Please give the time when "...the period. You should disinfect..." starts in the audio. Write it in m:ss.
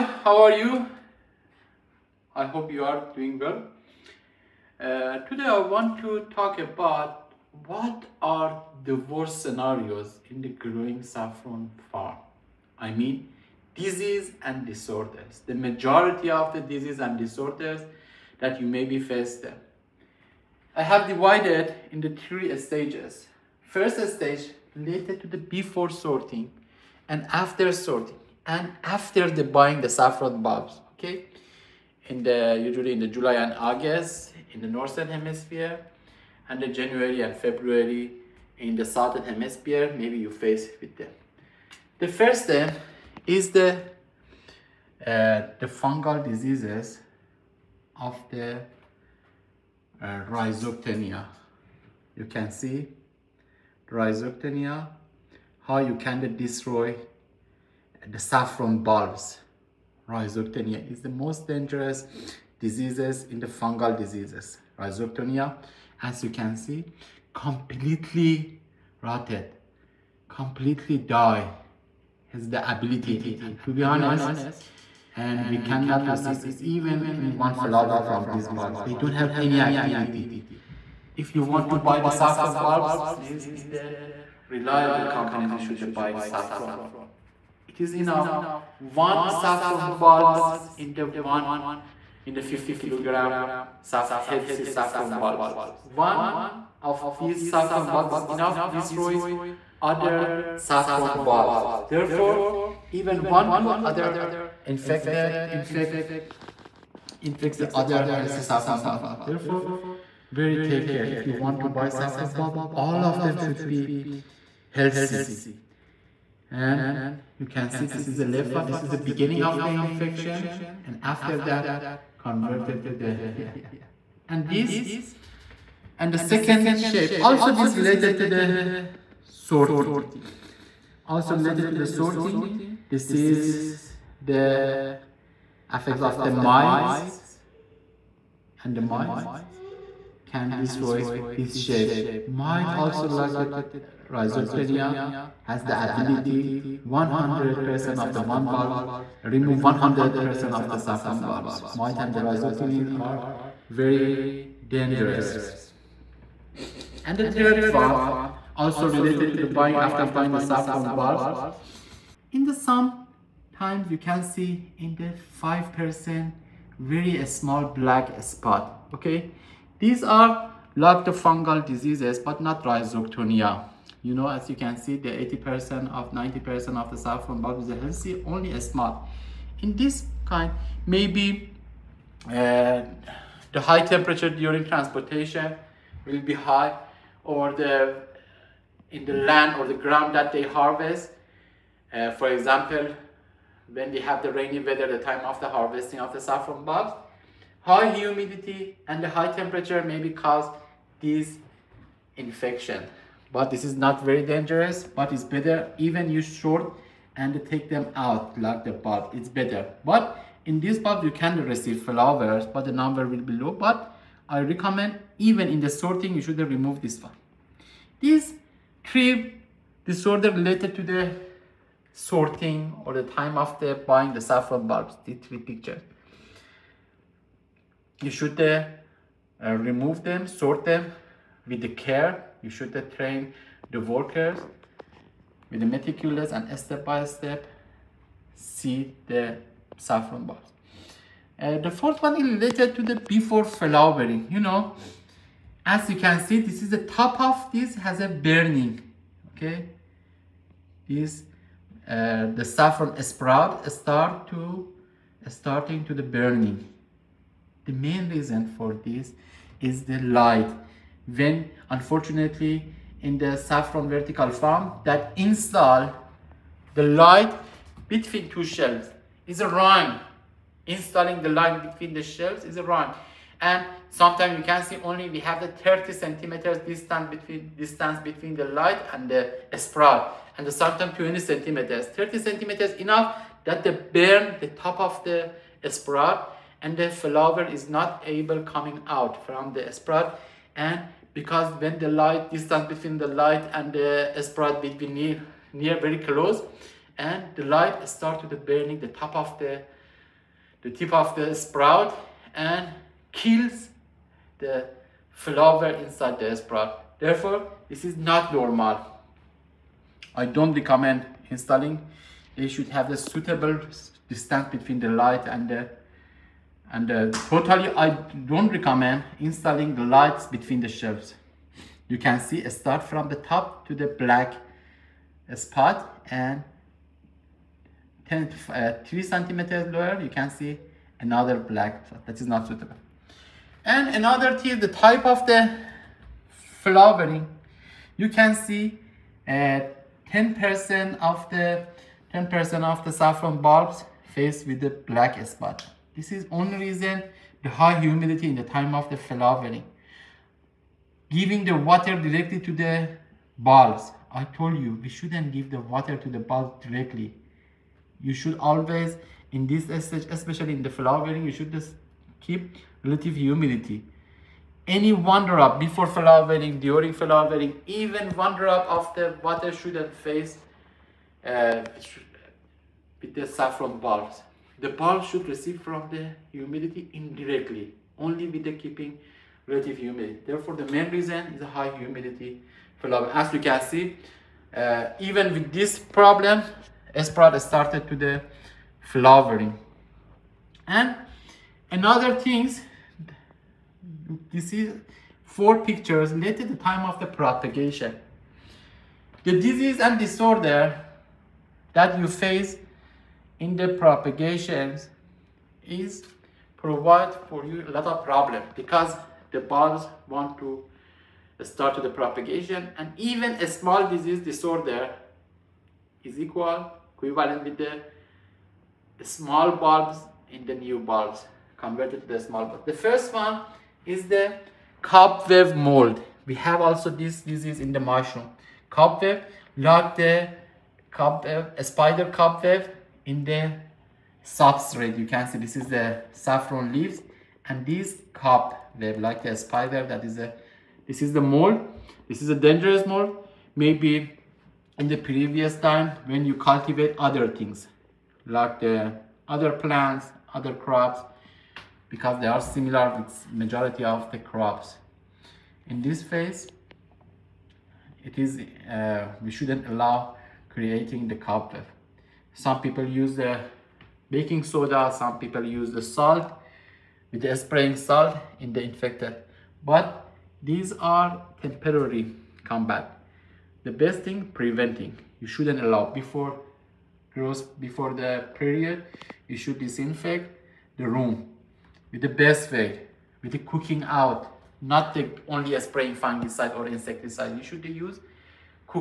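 7:57.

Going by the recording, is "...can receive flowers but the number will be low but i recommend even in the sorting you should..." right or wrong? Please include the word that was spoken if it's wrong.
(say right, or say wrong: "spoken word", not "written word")
right.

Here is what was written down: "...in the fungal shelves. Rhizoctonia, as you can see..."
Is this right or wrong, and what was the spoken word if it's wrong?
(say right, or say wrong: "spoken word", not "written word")
wrong: "diseases", not "shelves".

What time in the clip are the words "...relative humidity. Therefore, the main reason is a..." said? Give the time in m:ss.
6:19.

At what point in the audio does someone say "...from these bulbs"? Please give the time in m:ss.
1:18.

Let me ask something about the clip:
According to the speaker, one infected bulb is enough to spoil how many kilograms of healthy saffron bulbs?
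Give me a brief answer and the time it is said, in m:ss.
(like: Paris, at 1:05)
50 kilograms, at 1:32.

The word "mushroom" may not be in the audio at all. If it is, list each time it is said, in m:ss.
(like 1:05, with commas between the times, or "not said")
7:07.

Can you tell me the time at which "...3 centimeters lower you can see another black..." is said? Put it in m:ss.
5:28.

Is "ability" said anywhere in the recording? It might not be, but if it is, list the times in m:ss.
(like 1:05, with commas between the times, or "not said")
1:12, 2:25.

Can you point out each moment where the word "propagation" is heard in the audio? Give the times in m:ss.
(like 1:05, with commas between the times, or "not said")
6:37, 6:43, 6:52.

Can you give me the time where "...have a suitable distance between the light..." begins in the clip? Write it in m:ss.
5:12.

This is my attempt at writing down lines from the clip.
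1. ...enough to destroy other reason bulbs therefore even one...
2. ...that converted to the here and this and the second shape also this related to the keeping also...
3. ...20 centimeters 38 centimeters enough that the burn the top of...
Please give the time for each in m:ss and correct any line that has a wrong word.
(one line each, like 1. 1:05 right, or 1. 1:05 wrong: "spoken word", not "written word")
1. 1:38 wrong: "saffron", not "reason"
2. 2:01 wrong: "sorting", not "keeping"
3. 4:40 wrong: "30", not "38".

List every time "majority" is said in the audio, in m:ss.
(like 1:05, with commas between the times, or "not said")
0:15, 7:33.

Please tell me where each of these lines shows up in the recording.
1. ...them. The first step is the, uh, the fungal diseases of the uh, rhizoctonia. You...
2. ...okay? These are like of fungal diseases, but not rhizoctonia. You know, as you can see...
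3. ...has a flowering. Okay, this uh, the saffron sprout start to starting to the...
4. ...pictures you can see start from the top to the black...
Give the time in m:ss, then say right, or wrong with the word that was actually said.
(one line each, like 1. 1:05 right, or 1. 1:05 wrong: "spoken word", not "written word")
1. 0:40 right
2. 2:48 right
3. 4:07 wrong: "burning", not "flowering"
4. 5:20 wrong: "shelves", not "pictures".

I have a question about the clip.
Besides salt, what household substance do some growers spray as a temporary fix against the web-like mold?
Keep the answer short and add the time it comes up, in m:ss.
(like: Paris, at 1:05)
Baking soda, at 7:44.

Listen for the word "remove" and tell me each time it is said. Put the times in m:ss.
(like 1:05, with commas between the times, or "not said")
2:29, 3:36, 3:49.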